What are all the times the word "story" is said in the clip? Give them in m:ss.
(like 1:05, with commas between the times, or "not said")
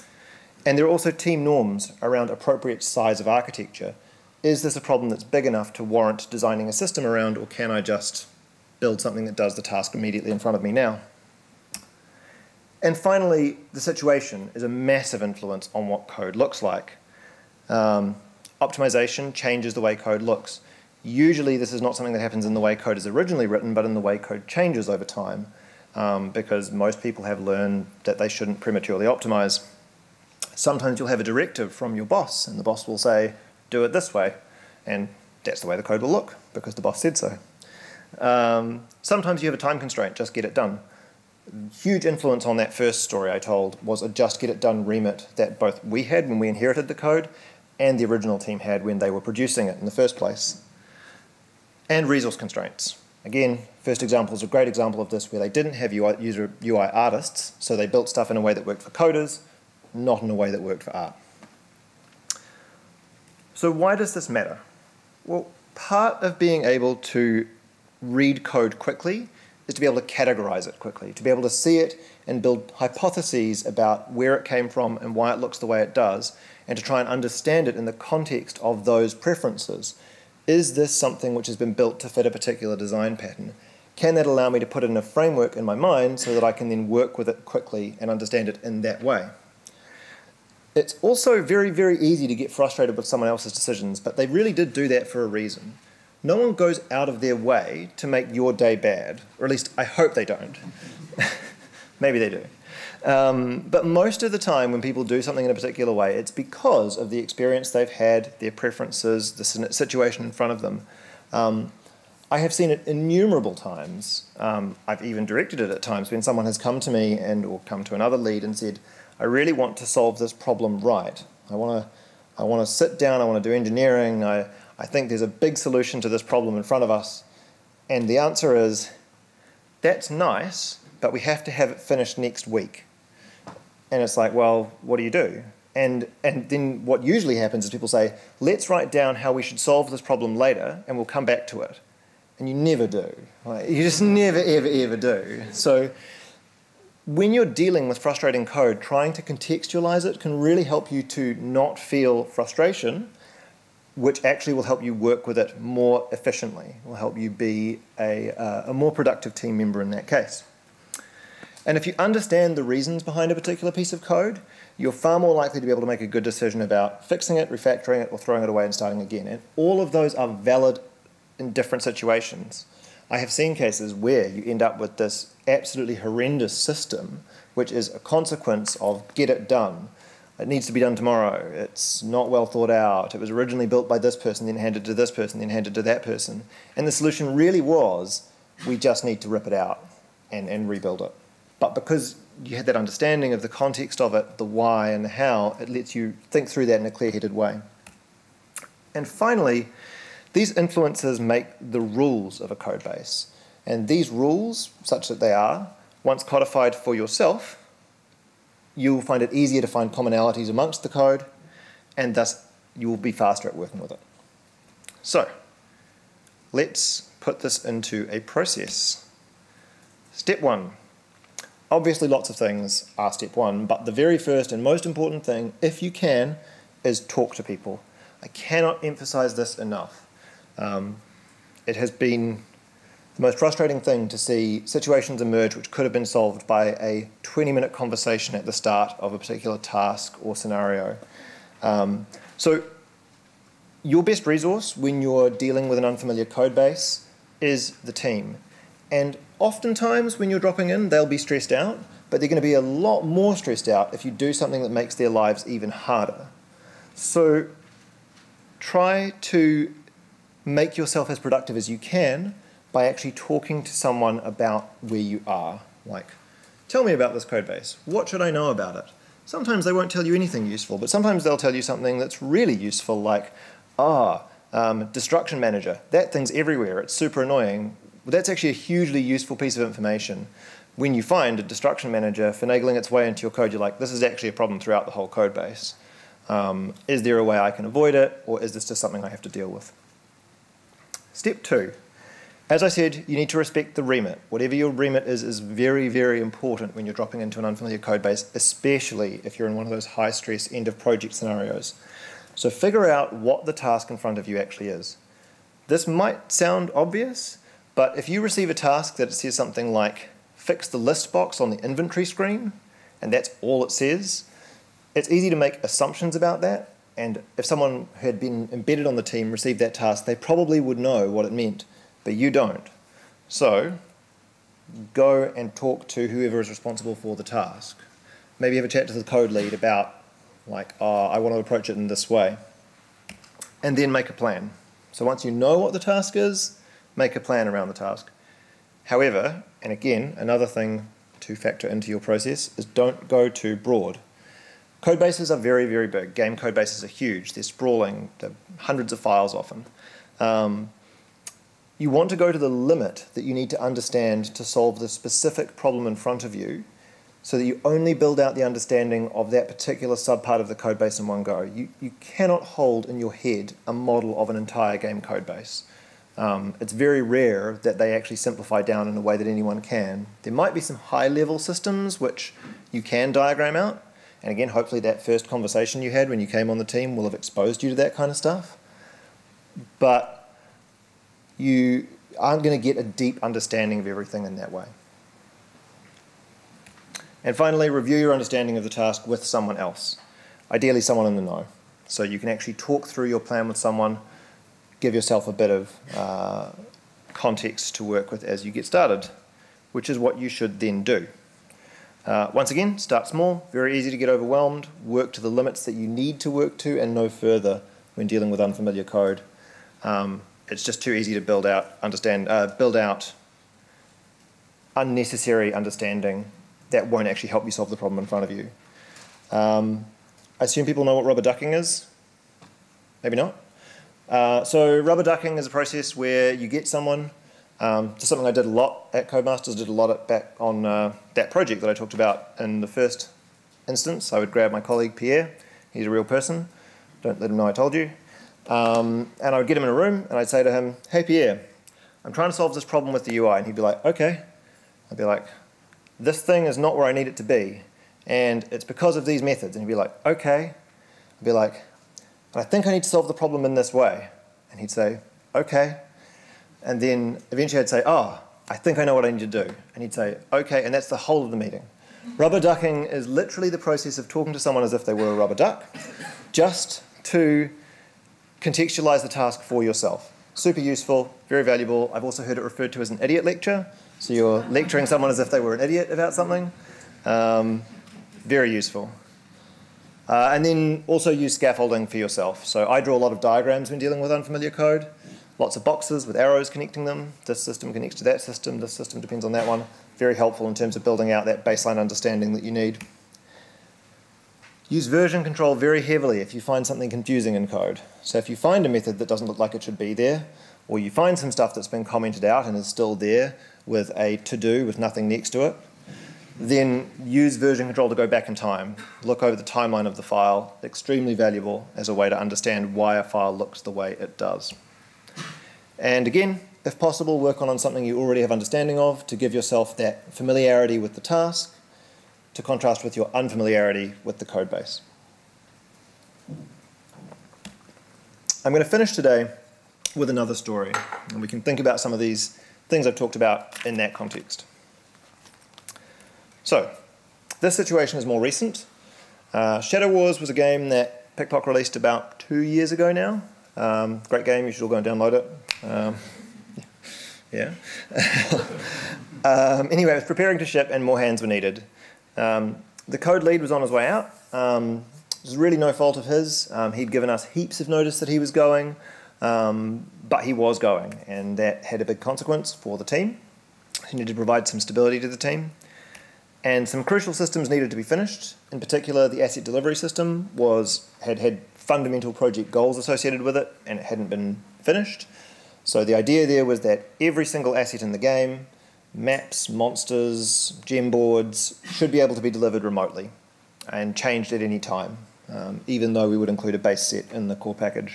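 0:43, 8:50.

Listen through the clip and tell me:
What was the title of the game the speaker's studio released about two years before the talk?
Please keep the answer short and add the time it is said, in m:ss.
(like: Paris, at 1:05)
Shadow Wars, at 8:59.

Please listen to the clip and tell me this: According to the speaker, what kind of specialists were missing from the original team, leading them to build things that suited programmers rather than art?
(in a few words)
UI artists.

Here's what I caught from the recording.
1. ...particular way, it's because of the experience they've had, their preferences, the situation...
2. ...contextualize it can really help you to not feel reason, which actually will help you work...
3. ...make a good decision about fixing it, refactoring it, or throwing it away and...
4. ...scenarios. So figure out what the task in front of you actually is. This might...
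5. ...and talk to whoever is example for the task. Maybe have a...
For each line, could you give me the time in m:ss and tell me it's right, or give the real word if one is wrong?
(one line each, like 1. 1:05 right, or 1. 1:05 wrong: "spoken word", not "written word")
1. 1:45 right
2. 2:29 wrong: "frustration", not "reason"
3. 2:45 right
4. 5:01 right
5. 5:25 wrong: "responsible", not "example".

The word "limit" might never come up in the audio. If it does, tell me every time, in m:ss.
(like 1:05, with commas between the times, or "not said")
5:52, 6:45.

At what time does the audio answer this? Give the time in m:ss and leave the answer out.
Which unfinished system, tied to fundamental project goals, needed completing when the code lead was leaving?
9:29.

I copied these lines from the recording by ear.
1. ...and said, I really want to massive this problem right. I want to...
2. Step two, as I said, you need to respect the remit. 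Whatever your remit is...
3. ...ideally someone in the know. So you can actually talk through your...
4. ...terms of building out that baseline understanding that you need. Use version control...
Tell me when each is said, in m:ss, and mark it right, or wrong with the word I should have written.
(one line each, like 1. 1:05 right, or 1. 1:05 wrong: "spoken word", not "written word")
1. 1:58 wrong: "solve", not "massive"
2. 4:51 right
3. 6:30 right
4. 8:10 right.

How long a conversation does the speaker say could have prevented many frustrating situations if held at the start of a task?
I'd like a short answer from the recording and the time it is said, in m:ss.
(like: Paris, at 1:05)
20 minutes, at 3:57.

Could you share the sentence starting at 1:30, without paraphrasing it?
It's also very, very easy to get frustrated with someone else's decisions, but they really did do that for a reason.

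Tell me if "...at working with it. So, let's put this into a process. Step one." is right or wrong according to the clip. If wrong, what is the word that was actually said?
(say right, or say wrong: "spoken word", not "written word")
right.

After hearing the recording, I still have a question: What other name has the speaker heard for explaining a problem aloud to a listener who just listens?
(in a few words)
Idiot lecture.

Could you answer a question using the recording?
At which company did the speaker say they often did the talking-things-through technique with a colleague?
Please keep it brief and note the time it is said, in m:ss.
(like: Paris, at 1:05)
Codemasters, at 7:09.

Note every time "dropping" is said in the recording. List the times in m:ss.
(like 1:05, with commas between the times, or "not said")
4:10, 4:56.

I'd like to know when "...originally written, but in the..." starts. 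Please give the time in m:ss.
0:23.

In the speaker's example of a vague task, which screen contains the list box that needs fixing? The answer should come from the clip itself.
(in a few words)
Inventory screen.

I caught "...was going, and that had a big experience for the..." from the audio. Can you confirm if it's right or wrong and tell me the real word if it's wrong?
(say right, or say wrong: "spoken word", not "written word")
wrong: "consequence", not "experience".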